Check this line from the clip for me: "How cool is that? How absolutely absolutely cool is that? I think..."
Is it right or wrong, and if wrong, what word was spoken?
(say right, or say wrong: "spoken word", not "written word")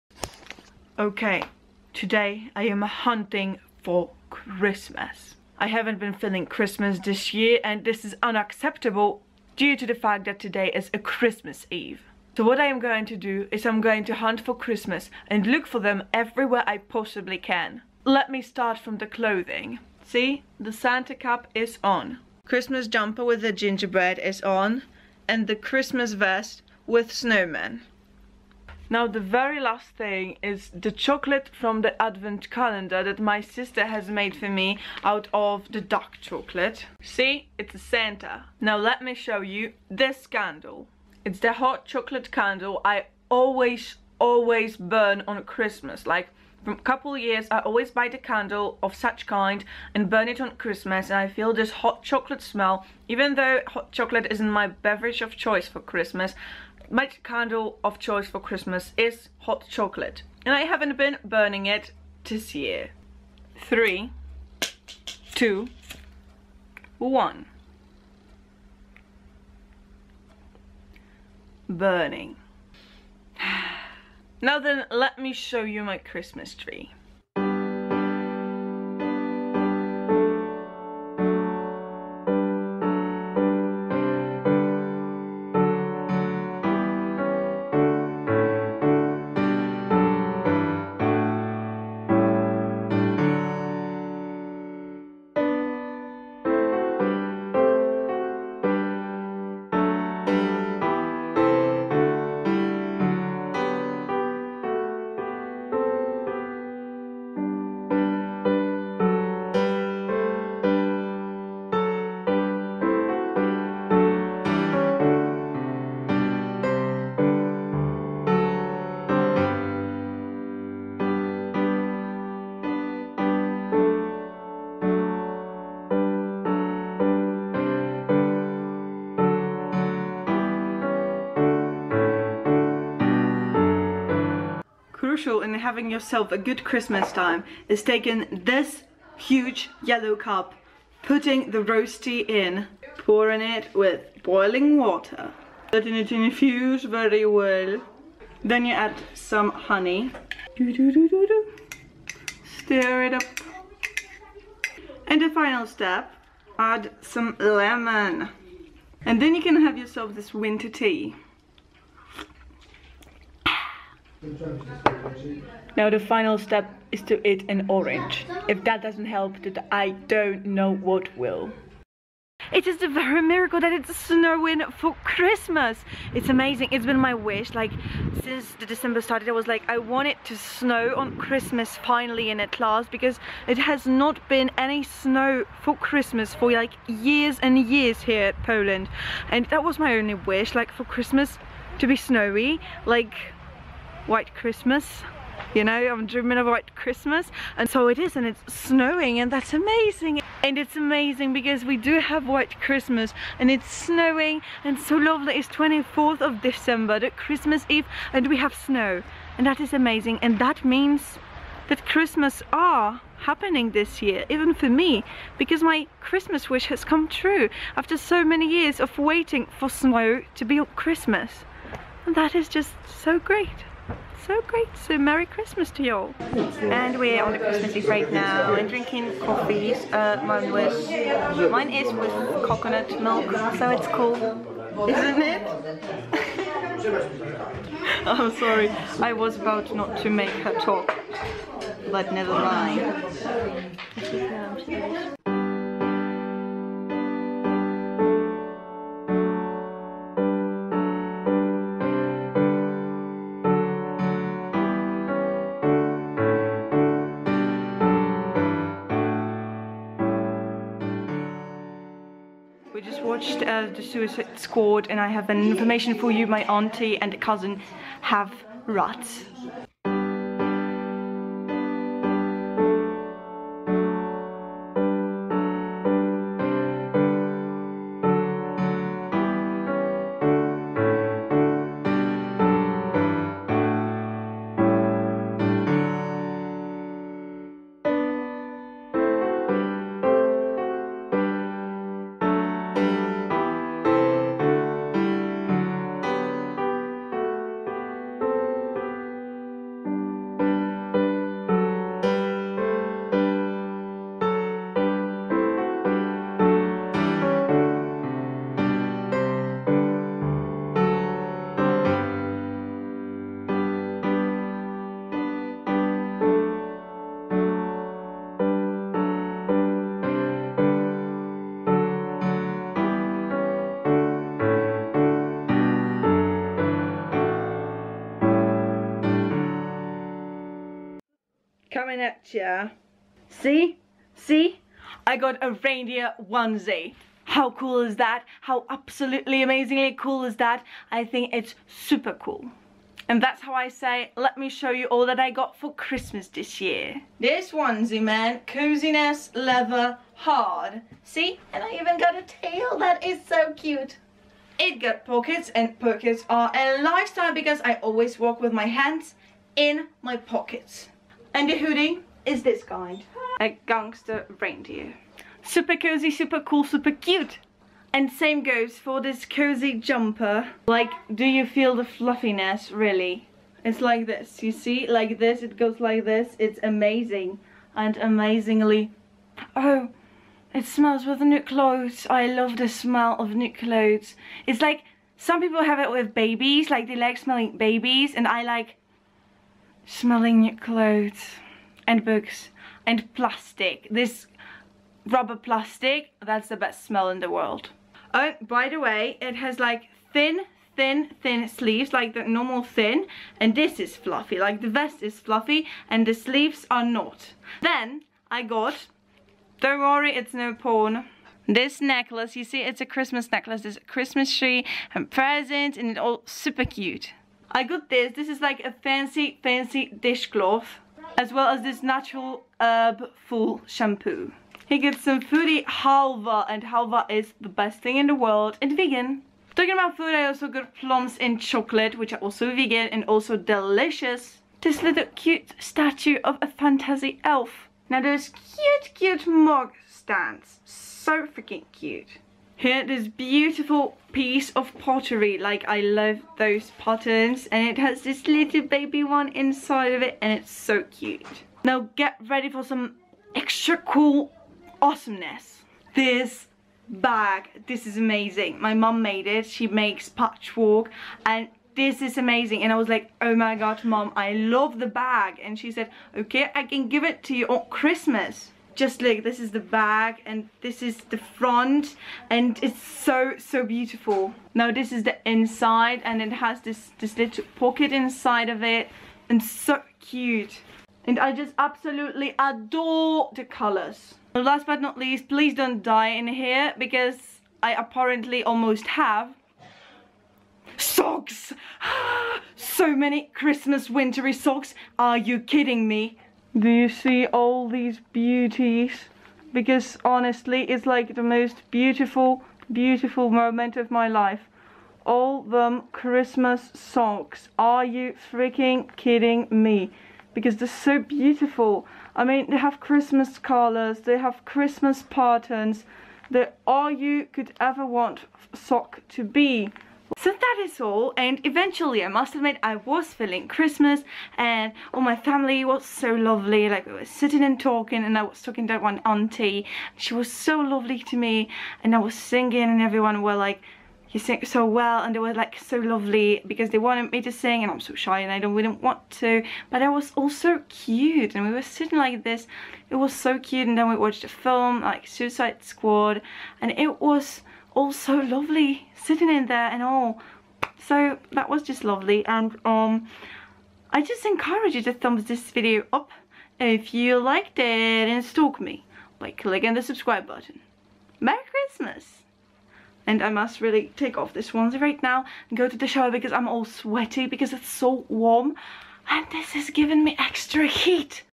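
wrong: "amazingly", not "absolutely".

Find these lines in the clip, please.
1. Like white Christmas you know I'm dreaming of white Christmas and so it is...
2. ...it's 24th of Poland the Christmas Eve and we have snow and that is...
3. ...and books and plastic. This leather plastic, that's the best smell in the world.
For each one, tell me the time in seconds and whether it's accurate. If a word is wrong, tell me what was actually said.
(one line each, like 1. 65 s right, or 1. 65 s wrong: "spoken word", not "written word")
1. 192 s right
2. 205 s wrong: "December", not "Poland"
3. 391 s wrong: "rubber", not "leather".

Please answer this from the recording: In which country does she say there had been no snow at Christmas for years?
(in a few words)
Poland.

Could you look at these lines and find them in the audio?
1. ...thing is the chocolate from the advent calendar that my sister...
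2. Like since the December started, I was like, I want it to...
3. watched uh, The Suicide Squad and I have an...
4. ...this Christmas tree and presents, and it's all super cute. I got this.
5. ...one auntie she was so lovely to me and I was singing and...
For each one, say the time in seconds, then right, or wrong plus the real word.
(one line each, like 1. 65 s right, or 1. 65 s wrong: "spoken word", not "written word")
1. 29 s right
2. 177 s right
3. 263 s right
4. 413 s right
5. 528 s right.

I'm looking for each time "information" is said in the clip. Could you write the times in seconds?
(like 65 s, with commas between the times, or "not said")
265 s.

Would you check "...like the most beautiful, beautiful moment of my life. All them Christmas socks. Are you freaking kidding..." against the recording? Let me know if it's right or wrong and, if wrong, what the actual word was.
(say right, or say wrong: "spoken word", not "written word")
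right.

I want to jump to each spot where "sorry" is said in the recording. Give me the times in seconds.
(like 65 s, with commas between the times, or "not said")
238 s.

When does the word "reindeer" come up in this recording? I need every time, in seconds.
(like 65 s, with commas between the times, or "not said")
335 s, 364 s.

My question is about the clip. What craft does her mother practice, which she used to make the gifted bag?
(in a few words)
Patchwork.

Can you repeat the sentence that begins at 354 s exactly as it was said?
It got pockets, and pockets are a lifestyle because I always walk with my hands in my pockets.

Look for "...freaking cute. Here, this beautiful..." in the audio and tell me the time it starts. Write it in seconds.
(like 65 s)
441 s.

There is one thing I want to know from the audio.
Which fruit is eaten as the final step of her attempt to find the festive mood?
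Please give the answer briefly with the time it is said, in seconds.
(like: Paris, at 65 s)
An orange, at 167 s.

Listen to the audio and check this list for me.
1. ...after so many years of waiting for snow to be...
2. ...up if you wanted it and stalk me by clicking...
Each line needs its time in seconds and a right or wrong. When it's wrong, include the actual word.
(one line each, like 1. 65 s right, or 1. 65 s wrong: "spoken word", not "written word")
1. 217 s right
2. 555 s wrong: "liked", not "wanted".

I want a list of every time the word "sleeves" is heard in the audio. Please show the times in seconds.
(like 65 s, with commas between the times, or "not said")
401 s, 406 s.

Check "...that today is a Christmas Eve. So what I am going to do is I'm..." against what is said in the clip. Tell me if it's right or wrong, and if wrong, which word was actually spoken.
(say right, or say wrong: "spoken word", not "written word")
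right.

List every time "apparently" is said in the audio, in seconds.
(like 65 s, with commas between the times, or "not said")
487 s.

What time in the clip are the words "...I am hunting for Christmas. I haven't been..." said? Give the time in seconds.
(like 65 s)
2 s.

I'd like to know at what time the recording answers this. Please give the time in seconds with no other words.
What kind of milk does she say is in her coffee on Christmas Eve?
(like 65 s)
232 s.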